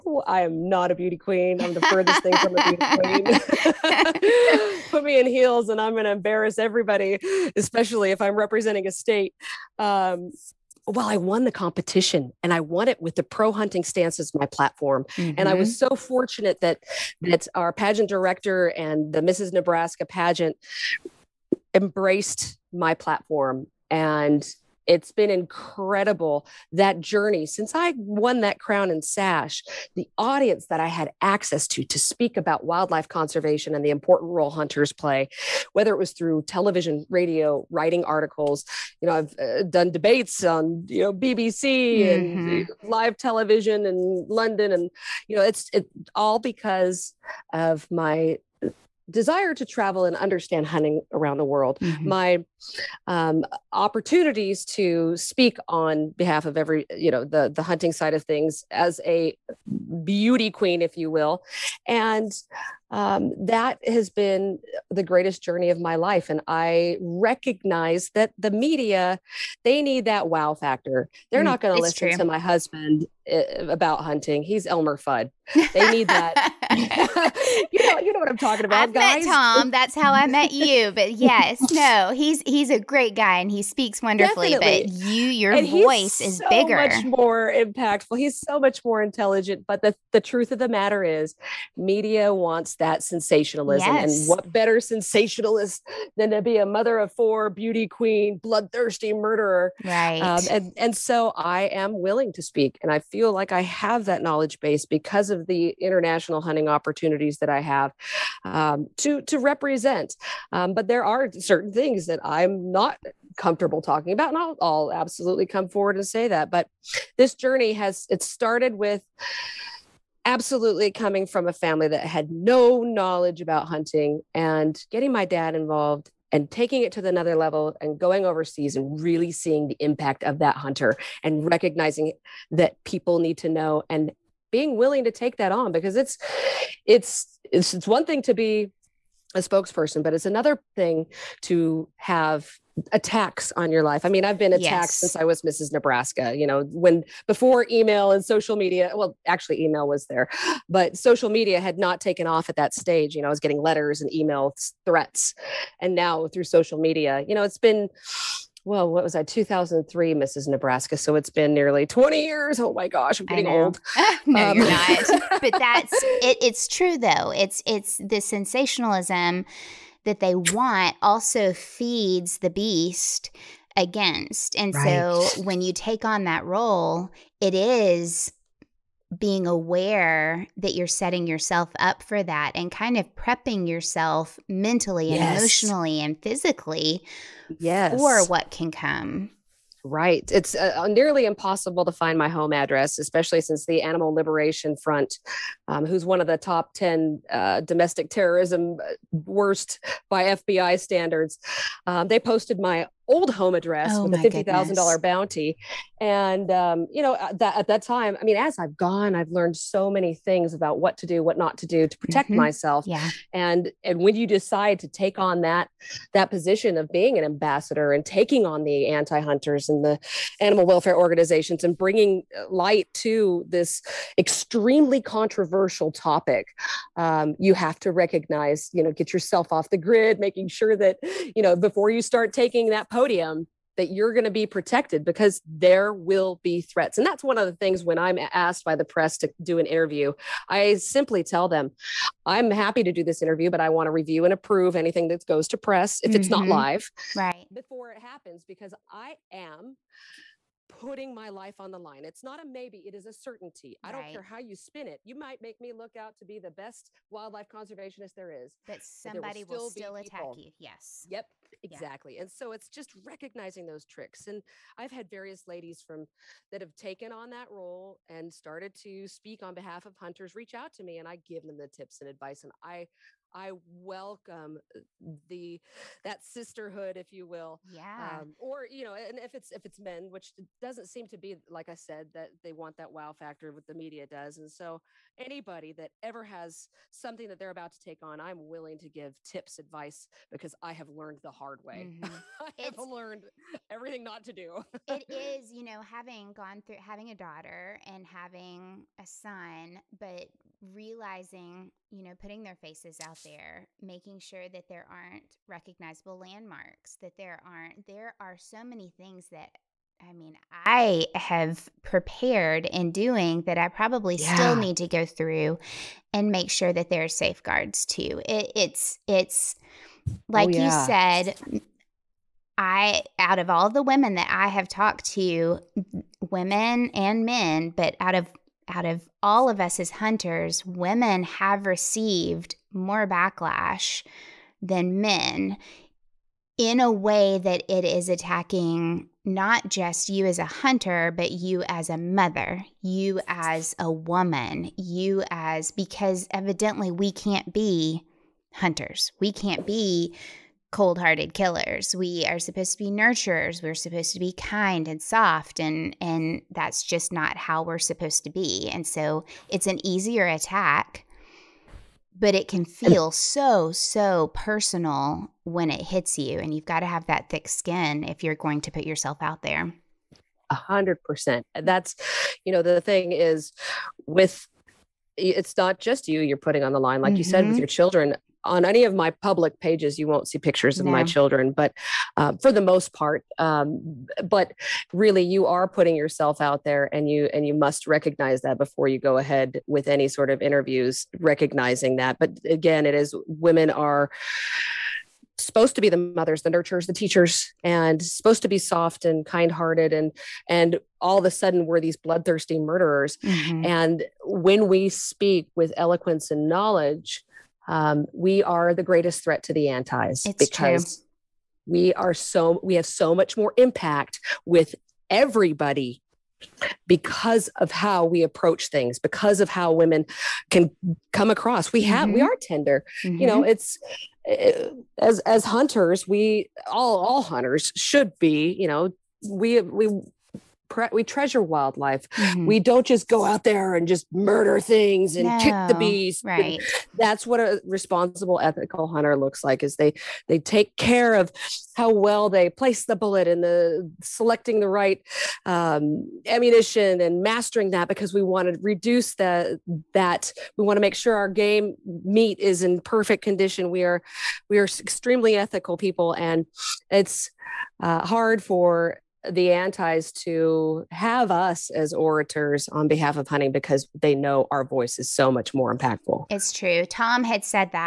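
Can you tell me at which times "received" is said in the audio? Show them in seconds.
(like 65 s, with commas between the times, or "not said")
331 s.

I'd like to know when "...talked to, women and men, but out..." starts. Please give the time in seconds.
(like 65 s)
324 s.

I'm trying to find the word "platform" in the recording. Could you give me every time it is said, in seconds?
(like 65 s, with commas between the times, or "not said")
14 s, 22 s.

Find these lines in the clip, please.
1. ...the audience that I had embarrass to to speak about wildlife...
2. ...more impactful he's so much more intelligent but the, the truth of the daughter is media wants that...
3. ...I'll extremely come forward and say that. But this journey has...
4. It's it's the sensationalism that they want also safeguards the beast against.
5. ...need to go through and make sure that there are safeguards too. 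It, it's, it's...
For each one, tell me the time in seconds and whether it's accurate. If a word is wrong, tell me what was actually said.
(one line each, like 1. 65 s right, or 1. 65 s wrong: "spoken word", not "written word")
1. 29 s wrong: "access", not "embarrass"
2. 87 s wrong: "matter", not "daughter"
3. 114 s wrong: "absolutely", not "extremely"
4. 167 s wrong: "feeds", not "safeguards"
5. 314 s right.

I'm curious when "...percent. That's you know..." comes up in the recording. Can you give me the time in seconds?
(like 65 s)
371 s.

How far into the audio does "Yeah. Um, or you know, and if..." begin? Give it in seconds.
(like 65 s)
277 s.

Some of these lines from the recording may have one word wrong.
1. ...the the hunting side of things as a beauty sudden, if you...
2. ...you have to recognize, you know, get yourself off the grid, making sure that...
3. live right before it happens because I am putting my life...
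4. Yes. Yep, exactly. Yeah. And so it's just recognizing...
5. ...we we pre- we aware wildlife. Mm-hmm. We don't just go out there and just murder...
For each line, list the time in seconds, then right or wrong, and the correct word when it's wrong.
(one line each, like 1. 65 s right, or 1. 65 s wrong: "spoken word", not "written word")
1. 57 s wrong: "queen", not "sudden"
2. 227 s right
3. 246 s right
4. 260 s right
5. 429 s wrong: "treasure", not "aware".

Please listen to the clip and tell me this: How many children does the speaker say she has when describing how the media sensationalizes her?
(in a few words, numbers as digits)
4.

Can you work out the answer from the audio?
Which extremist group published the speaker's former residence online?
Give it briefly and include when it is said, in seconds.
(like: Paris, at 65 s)
Animal Liberation Front, at 193 s.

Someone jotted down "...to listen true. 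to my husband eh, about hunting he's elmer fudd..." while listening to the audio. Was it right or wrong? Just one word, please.
right.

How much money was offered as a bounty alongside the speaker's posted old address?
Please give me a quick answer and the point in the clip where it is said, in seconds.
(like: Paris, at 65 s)
$50,000, at 204 s.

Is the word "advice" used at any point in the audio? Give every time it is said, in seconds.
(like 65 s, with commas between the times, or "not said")
272 s, 289 s.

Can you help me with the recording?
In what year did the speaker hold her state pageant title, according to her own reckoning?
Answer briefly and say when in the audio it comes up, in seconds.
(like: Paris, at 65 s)
2003, at 159 s.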